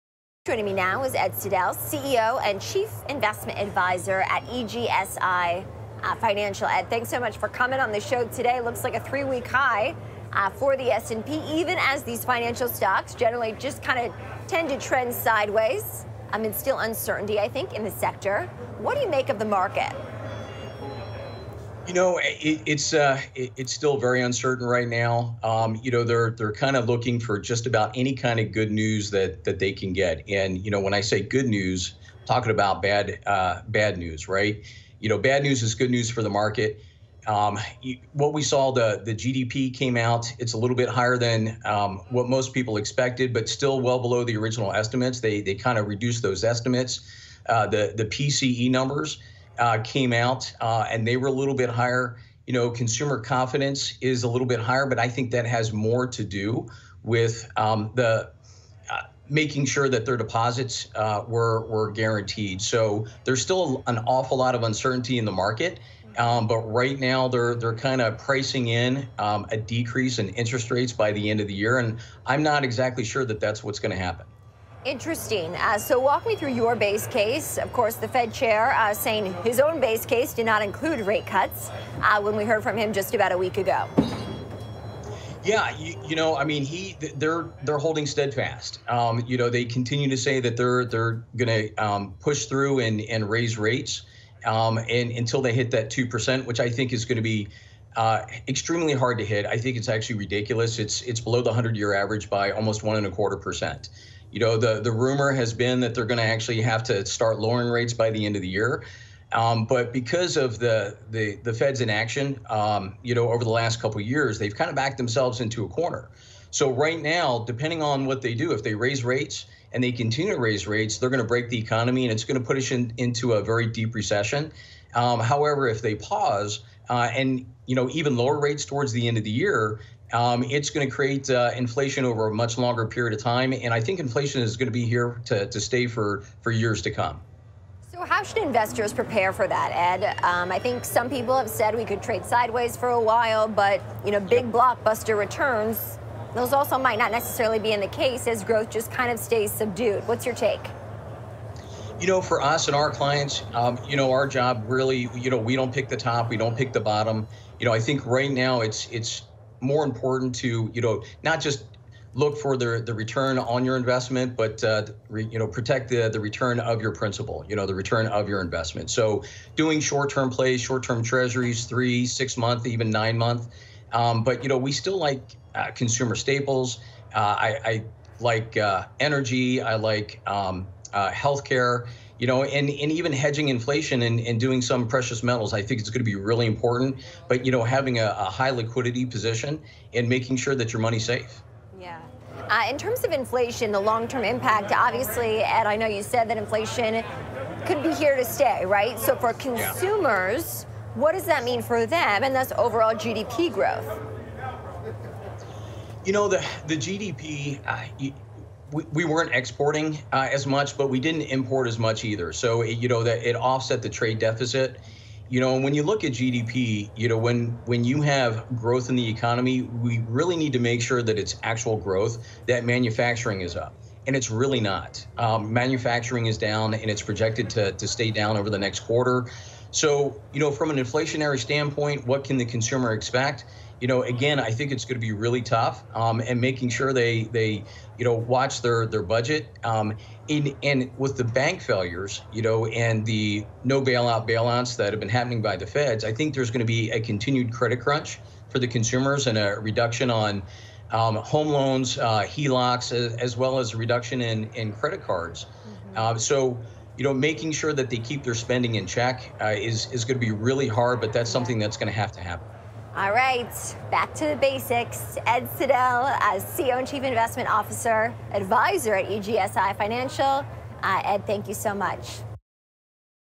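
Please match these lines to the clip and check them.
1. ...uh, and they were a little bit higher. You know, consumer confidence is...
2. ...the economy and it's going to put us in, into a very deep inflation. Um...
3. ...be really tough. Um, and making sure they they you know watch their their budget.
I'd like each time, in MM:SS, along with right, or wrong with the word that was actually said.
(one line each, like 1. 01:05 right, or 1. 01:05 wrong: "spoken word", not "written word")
1. 00:50 right
2. 02:01 wrong: "recession", not "inflation"
3. 03:55 right.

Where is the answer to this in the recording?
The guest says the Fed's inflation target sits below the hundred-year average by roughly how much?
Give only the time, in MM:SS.
01:42.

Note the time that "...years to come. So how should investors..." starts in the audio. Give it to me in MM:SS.
02:16.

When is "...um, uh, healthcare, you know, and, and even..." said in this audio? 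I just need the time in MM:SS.
03:00.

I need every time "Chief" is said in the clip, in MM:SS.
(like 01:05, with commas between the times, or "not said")
00:02, 04:26.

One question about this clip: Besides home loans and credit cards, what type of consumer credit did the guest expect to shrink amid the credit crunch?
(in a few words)
HELOCs.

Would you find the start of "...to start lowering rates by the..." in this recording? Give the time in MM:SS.
01:46.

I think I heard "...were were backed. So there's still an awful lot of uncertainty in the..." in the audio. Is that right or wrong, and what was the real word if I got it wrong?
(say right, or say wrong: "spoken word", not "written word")
wrong: "guaranteed", not "backed".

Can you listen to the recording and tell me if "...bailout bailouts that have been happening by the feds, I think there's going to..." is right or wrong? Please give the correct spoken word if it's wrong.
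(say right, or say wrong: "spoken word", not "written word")
right.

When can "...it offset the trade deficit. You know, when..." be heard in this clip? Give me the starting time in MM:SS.
03:33.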